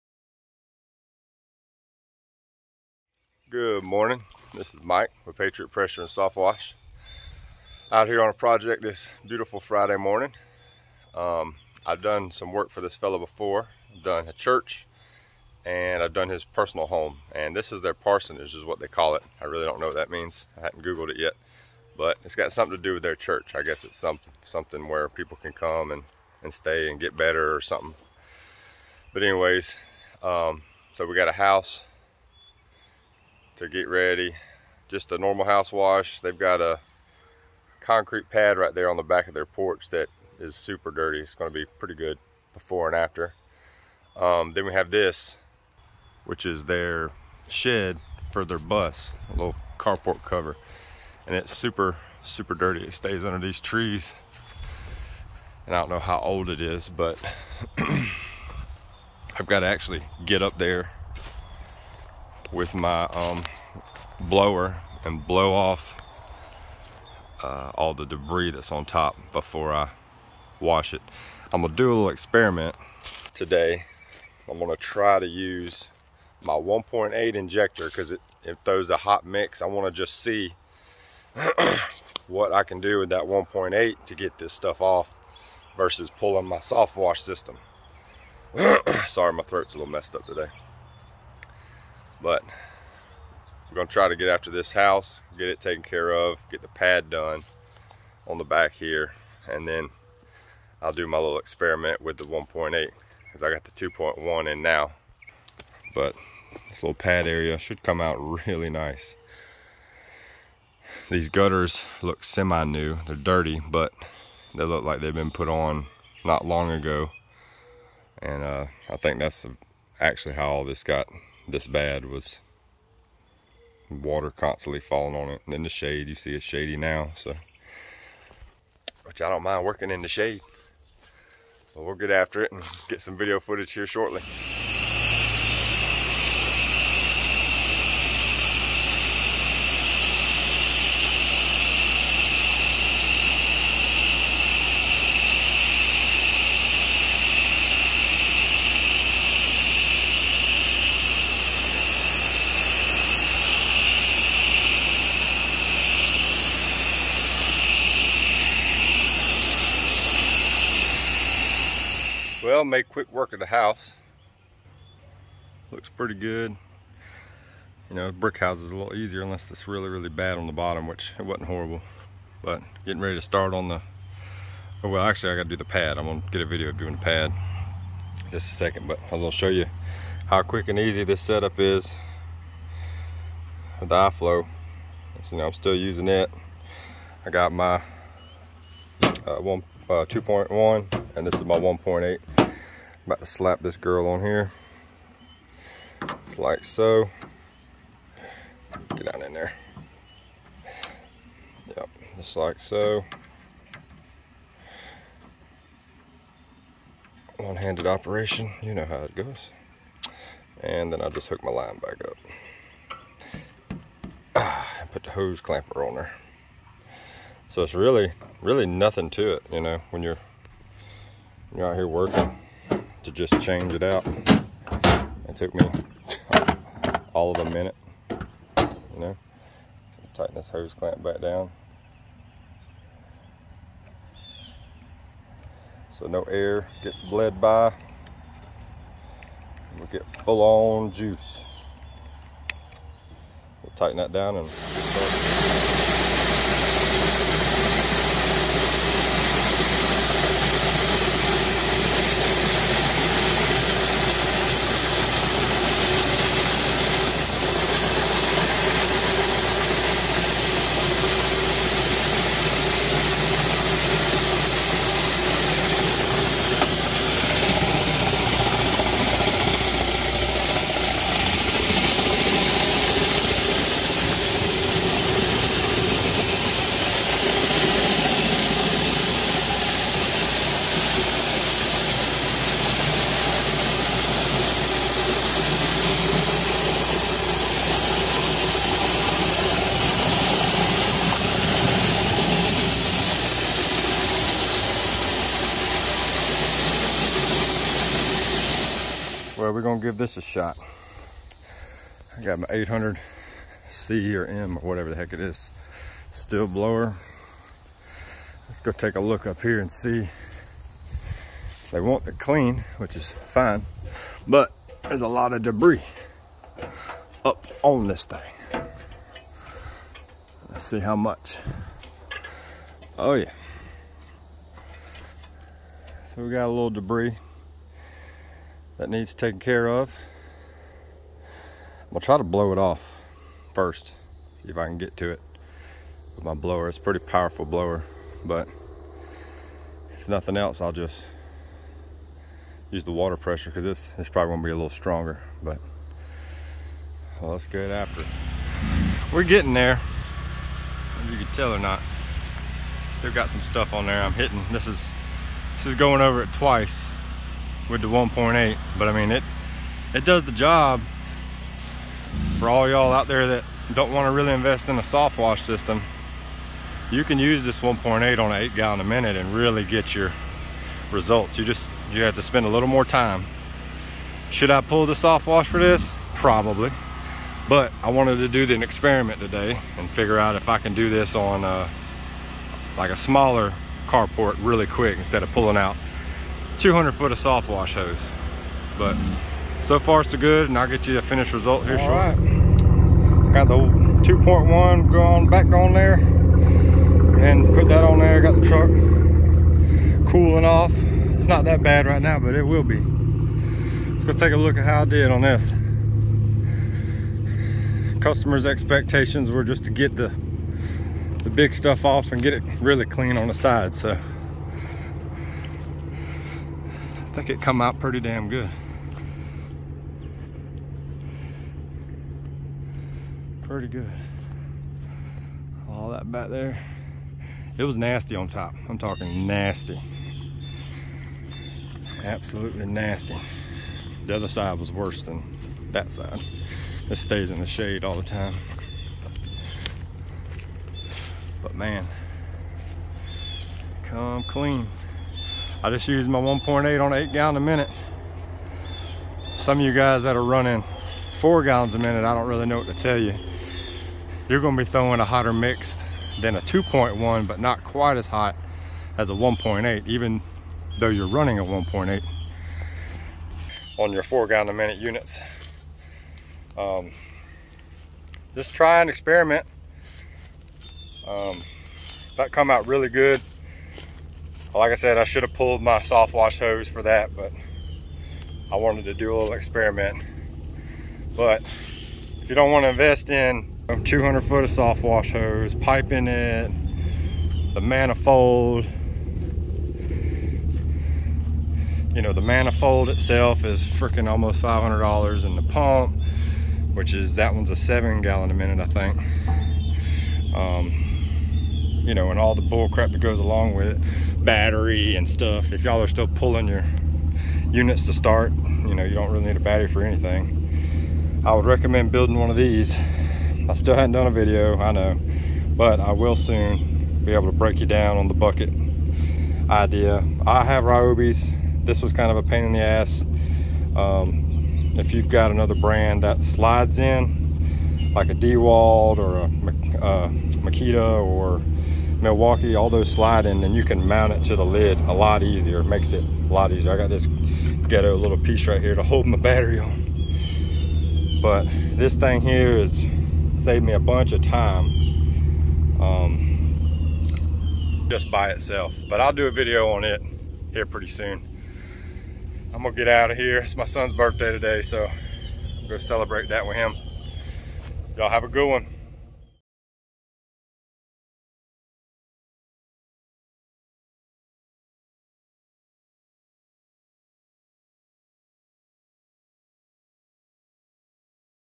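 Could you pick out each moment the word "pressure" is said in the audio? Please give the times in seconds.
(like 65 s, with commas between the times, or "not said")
5 s, 343 s.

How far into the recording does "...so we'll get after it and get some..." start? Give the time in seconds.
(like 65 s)
131 s.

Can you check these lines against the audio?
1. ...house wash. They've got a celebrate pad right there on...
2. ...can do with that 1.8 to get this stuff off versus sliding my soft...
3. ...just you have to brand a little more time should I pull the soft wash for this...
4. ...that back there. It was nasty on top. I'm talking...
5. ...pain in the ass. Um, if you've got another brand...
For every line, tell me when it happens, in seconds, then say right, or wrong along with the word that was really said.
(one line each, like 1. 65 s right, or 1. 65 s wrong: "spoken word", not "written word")
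1. 35 s wrong: "concrete", not "celebrate"
2. 82 s wrong: "pulling", not "sliding"
3. 371 s wrong: "spend", not "brand"
4. 425 s right
5. 522 s right.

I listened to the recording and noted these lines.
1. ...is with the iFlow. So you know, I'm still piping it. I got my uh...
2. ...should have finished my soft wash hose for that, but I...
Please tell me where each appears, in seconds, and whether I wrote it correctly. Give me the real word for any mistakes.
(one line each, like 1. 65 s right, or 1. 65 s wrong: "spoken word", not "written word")
1. 181 s wrong: "using", not "piping"
2. 475 s wrong: "pulled", not "finished".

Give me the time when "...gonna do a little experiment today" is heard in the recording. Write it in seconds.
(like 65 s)
71 s.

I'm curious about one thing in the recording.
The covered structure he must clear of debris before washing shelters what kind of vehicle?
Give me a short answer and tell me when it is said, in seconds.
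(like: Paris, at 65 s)
bus, at 48 s.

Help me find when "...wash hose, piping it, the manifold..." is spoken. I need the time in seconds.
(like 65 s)
484 s.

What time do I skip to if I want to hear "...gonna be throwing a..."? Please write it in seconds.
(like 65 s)
454 s.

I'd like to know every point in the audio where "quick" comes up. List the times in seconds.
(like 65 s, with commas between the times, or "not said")
162 s, 180 s, 384 s.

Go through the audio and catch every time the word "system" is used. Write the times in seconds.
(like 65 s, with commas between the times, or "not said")
87 s, 365 s.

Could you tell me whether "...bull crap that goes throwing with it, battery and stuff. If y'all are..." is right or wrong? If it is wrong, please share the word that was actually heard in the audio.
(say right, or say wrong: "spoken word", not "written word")
wrong: "along", not "throwing".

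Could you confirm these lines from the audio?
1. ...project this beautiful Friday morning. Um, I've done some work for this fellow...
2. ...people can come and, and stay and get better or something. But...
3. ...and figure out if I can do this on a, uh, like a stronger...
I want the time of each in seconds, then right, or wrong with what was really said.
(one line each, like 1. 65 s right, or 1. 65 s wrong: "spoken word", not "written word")
1. 8 s right
2. 25 s right
3. 379 s wrong: "smaller", not "stronger".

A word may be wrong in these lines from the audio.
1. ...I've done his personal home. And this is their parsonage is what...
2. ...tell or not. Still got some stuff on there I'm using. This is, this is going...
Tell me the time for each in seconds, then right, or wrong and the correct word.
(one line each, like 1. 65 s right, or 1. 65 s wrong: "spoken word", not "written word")
1. 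16 s right
2. 351 s wrong: "hitting", not "using".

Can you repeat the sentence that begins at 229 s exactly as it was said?
So tighten this hose clamp back down.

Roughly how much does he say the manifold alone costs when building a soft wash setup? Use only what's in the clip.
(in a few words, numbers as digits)
$500.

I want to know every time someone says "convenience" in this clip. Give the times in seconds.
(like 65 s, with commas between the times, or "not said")
not said.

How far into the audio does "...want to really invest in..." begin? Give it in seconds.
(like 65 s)
363 s.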